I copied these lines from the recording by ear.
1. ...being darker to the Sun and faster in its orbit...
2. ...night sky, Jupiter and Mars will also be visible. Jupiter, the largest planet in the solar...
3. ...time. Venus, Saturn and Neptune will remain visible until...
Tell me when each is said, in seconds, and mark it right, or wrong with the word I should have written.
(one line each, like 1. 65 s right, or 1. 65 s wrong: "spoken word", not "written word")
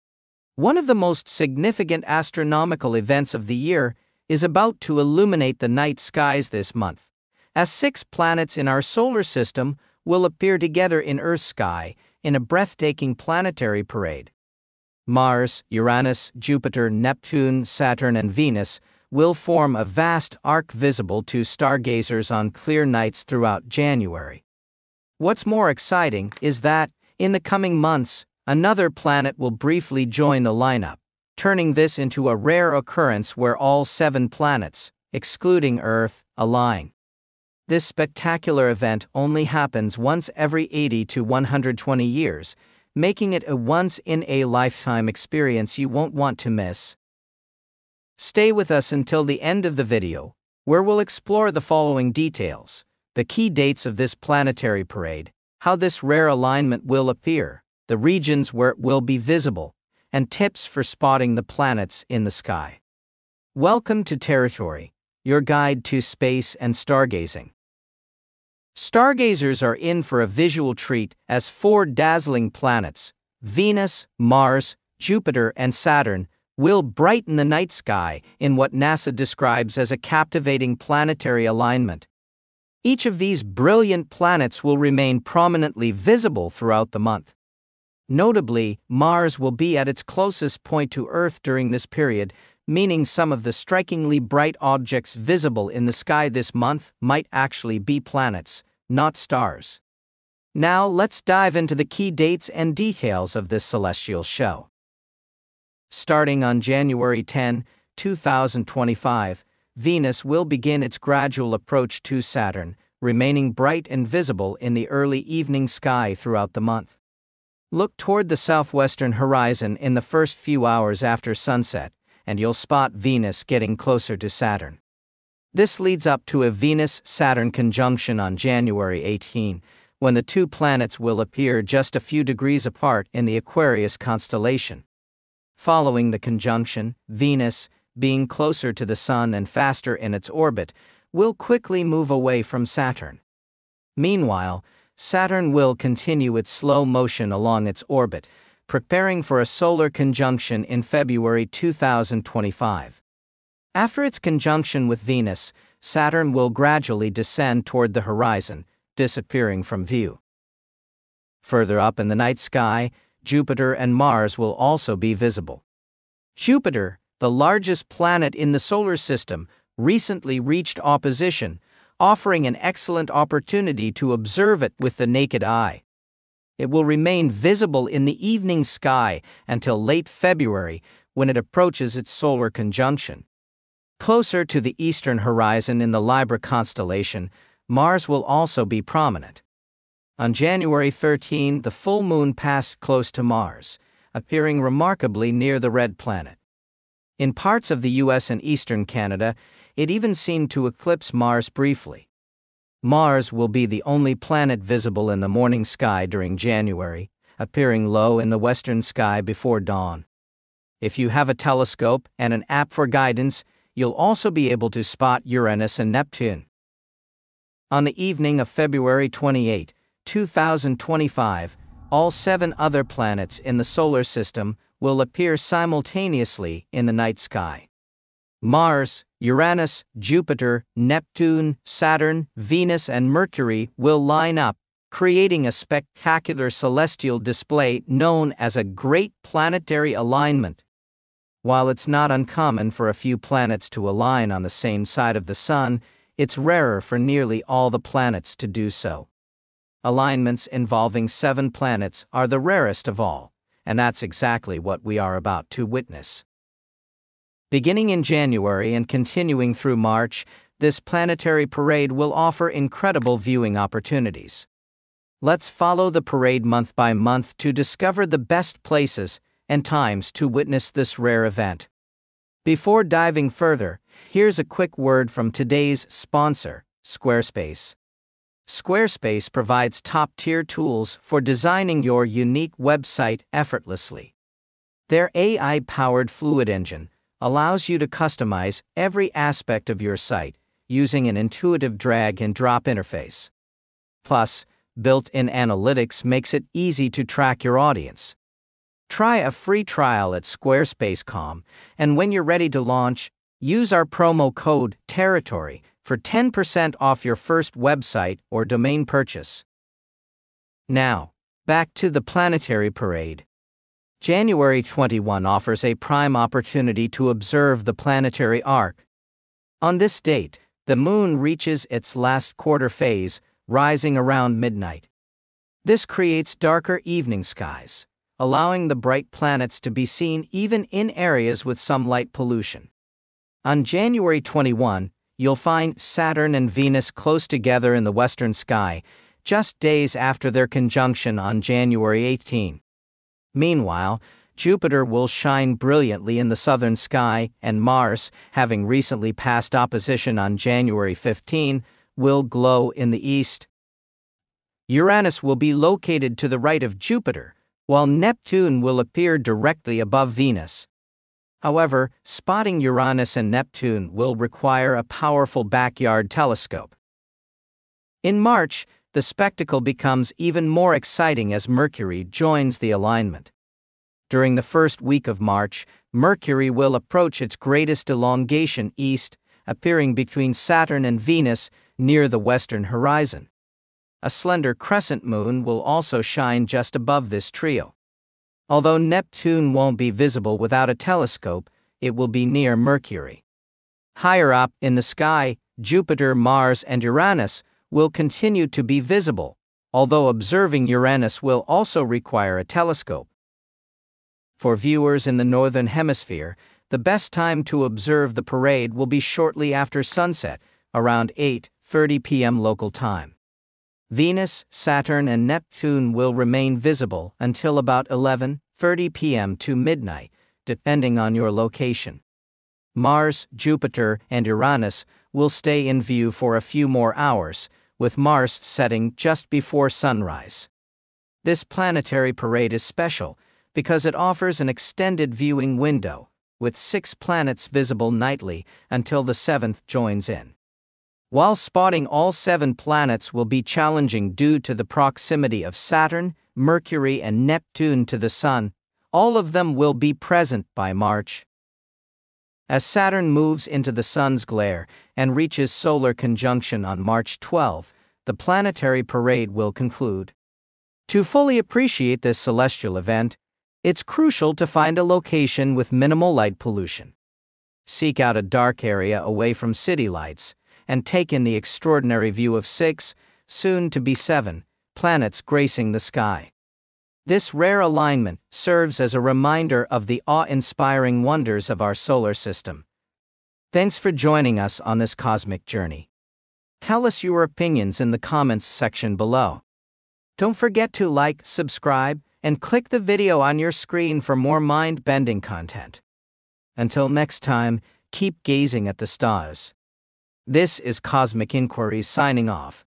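1. 137 s wrong: "closer", not "darker"
2. 162 s right
3. 412 s right.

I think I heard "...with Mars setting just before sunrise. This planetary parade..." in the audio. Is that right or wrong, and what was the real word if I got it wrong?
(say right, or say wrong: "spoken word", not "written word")
right.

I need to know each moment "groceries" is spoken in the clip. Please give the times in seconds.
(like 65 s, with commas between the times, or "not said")
not said.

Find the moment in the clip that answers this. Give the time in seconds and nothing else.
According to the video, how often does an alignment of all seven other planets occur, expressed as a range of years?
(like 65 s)
40 s.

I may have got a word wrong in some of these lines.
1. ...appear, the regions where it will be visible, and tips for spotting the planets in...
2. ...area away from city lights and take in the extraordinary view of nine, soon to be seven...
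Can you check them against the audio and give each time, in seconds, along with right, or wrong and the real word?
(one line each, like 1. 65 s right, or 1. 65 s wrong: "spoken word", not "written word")
1. 57 s right
2. 468 s wrong: "six", not "nine".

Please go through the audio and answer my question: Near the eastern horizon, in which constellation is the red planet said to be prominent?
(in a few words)
Libra.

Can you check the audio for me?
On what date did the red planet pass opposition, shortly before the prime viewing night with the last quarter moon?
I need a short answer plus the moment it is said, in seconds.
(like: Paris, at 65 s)
January 15, at 350 s.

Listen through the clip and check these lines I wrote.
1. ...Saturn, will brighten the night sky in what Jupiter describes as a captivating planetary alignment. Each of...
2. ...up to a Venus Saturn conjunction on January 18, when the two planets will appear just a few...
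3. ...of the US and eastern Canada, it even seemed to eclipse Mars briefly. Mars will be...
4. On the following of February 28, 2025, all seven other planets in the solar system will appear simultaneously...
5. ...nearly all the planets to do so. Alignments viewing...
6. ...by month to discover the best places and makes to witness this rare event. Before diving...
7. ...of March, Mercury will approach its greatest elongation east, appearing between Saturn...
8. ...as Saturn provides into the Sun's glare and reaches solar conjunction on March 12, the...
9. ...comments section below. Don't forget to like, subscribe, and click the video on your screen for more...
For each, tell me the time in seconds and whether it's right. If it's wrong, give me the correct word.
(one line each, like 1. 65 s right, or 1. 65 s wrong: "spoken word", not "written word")
1. 75 s wrong: "NASA", not "Jupiter"
2. 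126 s right
3. 197 s right
4. 217 s wrong: "evening", not "following"
5. 246 s wrong: "involving", not "viewing"
6. 266 s wrong: "times", not "makes"
7. 375 s right
8. 452 s wrong: "moves", not "provides"
9. 487 s right.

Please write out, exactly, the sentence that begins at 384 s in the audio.
A slender crescent moon will also shine just above this trio.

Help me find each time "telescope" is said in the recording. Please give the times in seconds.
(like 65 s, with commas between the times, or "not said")
211 s, 366 s, 390 s, 402 s.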